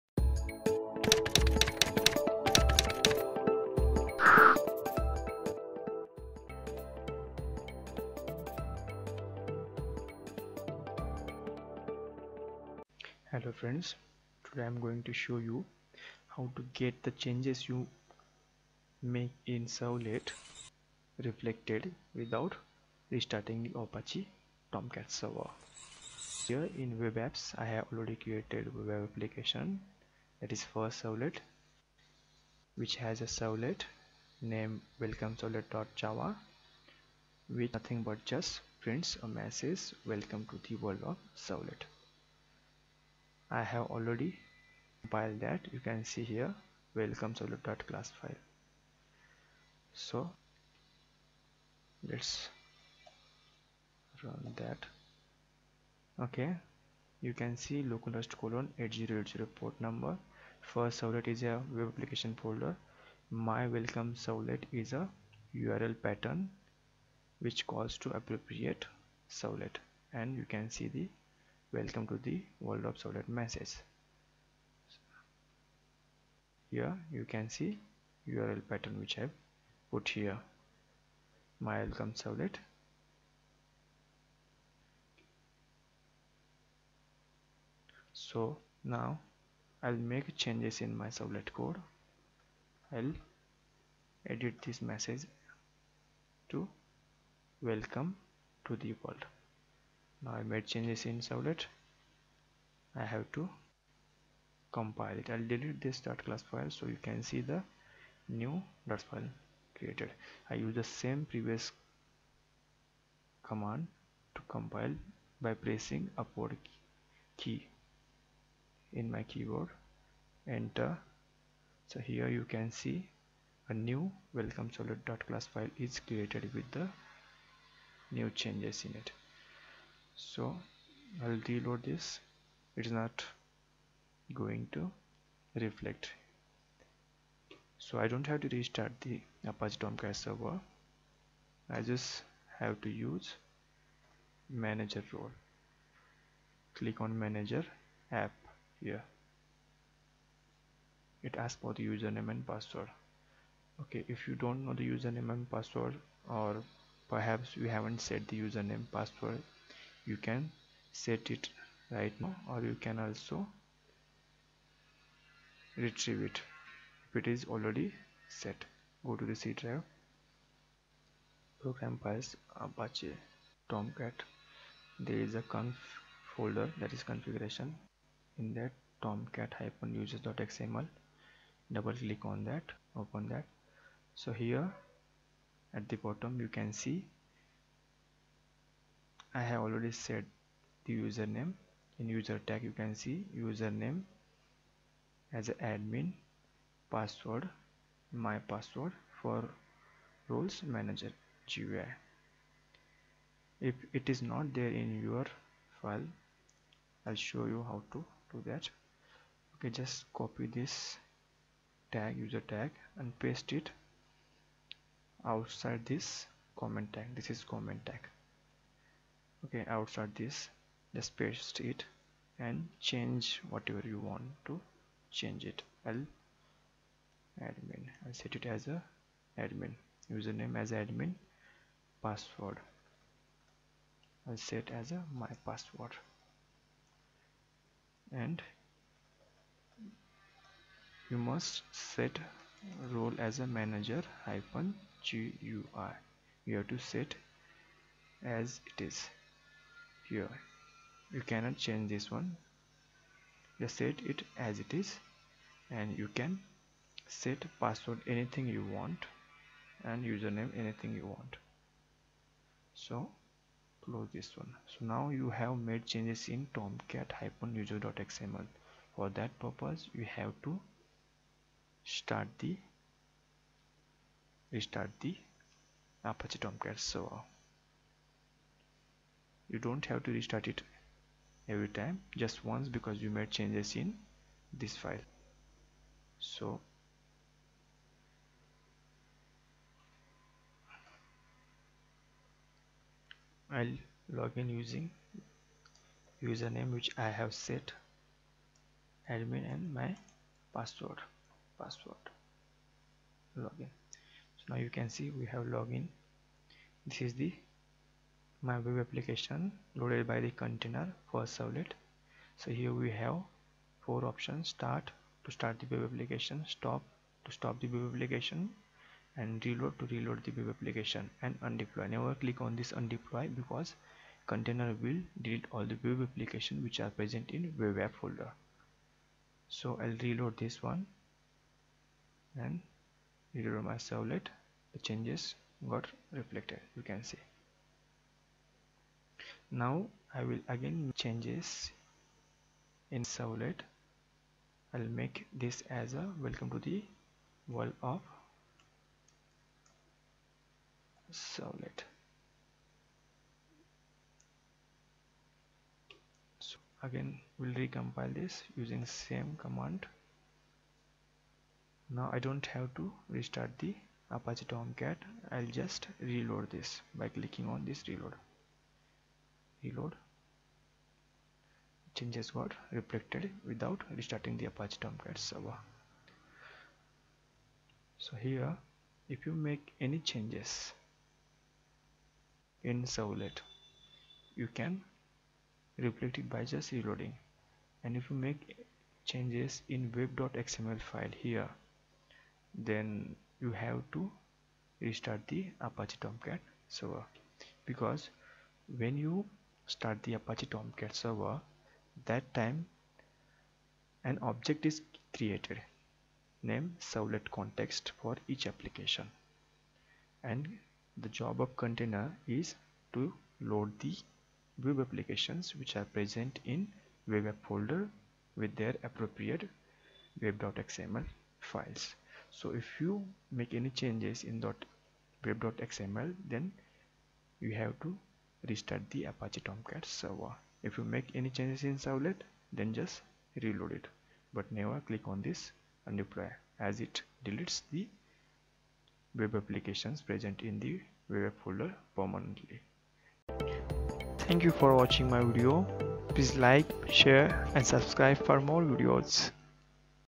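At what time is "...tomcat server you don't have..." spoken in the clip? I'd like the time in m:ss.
4:36.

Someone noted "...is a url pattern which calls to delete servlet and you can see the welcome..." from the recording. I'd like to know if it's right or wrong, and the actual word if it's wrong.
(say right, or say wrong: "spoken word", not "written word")
wrong: "appropriate", not "delete".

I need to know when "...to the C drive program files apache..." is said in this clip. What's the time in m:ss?
2:49.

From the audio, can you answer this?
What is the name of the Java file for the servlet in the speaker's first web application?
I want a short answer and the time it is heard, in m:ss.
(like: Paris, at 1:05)
welcome servlet.java, at 0:35.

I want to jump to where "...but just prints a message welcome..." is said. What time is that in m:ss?
0:38.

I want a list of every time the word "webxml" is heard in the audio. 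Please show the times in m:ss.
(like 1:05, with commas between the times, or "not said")
6:29, 7:00, 7:05.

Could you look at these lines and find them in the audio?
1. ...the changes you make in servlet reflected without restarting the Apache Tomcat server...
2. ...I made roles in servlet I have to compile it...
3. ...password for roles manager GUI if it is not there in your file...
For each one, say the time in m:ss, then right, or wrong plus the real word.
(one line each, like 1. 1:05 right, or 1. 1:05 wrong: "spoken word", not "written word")
1. 0:17 right
2. 1:40 wrong: "changes", not "roles"
3. 3:18 right.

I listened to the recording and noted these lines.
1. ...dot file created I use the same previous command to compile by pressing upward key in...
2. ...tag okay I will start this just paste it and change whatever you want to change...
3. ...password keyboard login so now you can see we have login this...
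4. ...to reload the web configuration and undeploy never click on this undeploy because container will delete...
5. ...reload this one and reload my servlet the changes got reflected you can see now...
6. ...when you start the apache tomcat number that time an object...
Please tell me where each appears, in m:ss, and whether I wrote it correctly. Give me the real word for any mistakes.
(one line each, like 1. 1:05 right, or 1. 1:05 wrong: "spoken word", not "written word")
1. 1:48 right
2. 3:37 right
3. 5:00 wrong: "password", not "keyboard"
4. 5:19 wrong: "application", not "configuration"
5. 5:30 right
6. 6:38 wrong: "server", not "number".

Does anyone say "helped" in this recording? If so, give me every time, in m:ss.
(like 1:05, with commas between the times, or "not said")
not said.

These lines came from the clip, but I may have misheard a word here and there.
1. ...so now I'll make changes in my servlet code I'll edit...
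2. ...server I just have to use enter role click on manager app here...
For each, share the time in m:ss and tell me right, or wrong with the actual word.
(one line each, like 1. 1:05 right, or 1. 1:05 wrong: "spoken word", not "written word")
1. 1:28 right
2. 2:20 wrong: "manager", not "enter".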